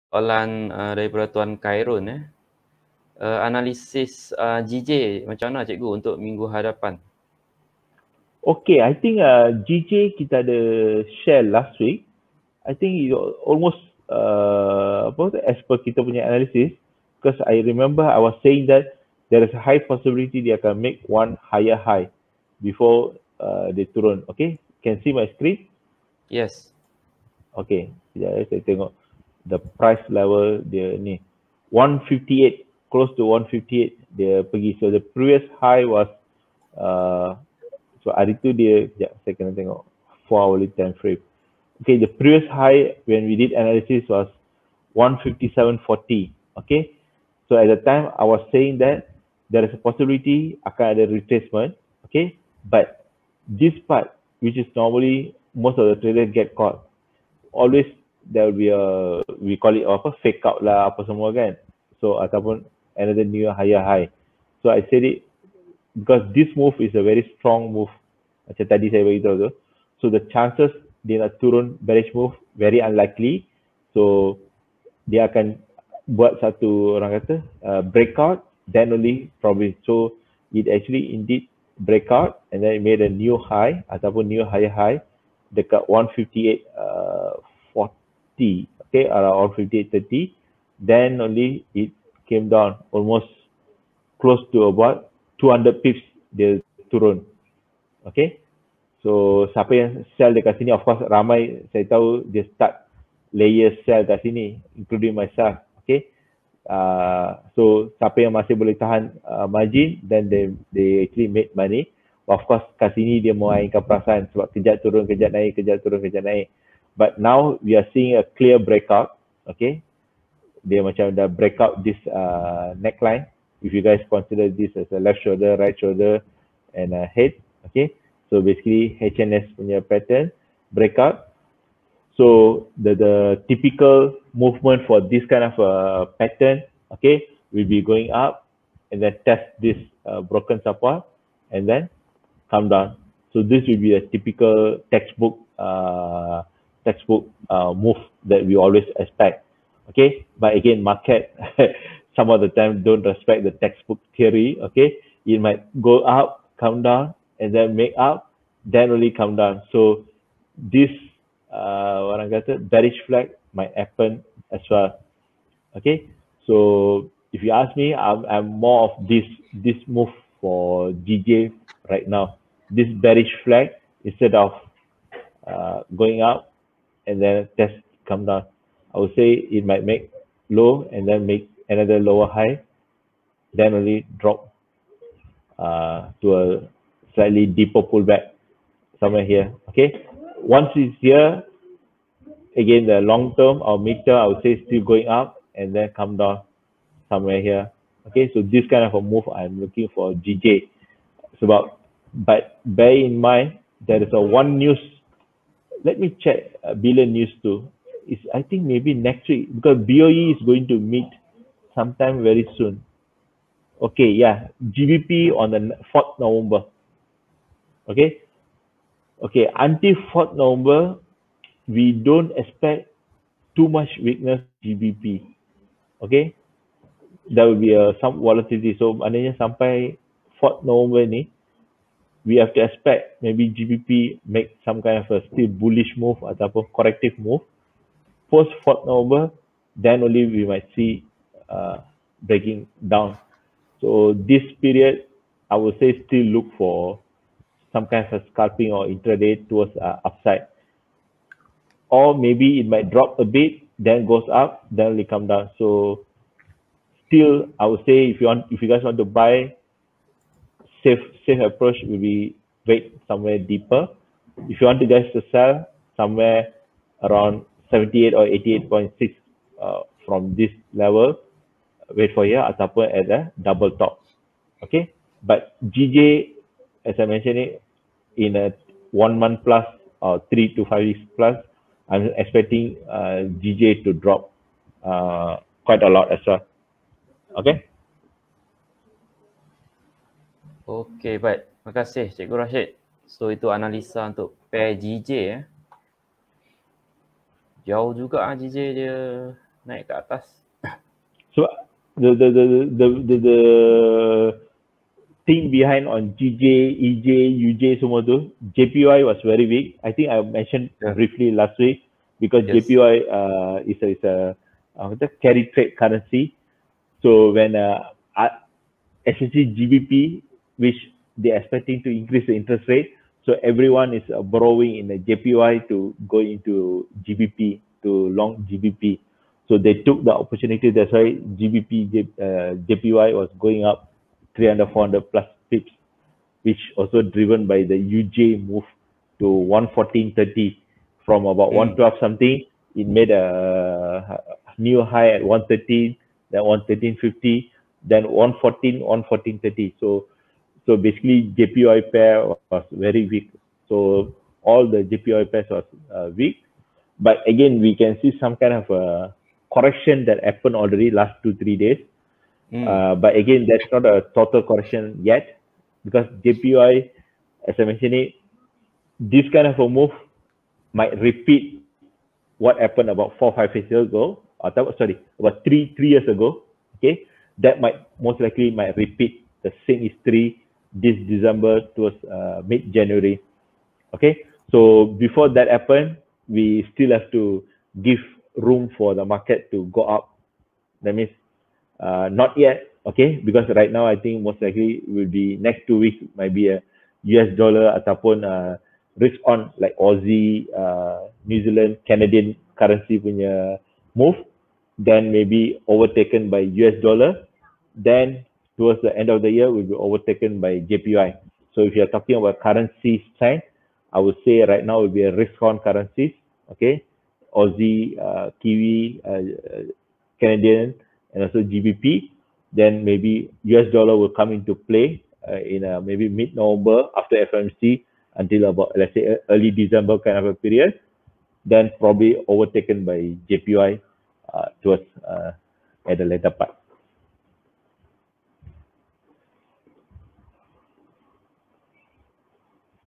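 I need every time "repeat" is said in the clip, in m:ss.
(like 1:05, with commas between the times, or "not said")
6:10, 6:18.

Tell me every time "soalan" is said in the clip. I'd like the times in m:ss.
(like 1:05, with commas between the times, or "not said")
0:00.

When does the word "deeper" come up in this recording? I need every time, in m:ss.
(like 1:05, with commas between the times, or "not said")
3:07, 4:23.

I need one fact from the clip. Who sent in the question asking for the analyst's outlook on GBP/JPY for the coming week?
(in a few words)
Tuan Khairun.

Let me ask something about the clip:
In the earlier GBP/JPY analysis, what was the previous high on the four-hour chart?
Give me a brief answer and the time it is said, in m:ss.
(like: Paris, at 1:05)
157.40, at 0:44.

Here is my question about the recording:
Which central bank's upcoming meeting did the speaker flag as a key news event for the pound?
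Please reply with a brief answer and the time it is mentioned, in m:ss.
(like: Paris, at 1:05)
BOE, at 3:29.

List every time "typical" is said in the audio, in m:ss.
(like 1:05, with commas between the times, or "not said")
2:13, 2:24.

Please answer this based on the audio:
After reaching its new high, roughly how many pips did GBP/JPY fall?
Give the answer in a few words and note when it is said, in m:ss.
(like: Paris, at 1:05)
200 pips, at 1:35.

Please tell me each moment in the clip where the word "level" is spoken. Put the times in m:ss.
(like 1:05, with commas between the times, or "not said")
0:30, 4:30.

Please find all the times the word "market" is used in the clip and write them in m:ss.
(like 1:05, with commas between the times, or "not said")
2:30, 6:29.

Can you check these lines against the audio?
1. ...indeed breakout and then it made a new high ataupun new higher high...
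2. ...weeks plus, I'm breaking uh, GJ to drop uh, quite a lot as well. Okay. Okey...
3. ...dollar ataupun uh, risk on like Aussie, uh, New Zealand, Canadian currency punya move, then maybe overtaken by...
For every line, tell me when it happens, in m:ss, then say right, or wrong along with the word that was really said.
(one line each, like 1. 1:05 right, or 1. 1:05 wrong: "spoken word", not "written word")
1. 1:21 right
2. 4:40 wrong: "expecting", not "breaking"
3. 6:37 right.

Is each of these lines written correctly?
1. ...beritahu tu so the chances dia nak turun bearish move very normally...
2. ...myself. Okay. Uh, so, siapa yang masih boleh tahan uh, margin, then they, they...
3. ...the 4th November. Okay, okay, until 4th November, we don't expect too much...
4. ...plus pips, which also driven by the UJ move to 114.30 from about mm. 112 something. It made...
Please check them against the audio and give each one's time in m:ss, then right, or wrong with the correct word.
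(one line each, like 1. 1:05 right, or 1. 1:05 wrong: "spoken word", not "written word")
1. 1:09 wrong: "unlikely", not "normally"
2. 1:45 right
3. 3:35 right
4. 5:35 right.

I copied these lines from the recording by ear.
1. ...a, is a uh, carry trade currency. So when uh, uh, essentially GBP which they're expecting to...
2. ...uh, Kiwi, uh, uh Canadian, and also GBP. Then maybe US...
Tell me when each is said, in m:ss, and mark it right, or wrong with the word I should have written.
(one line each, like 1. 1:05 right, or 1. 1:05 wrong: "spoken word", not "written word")
1. 5:13 right
2. 6:57 right.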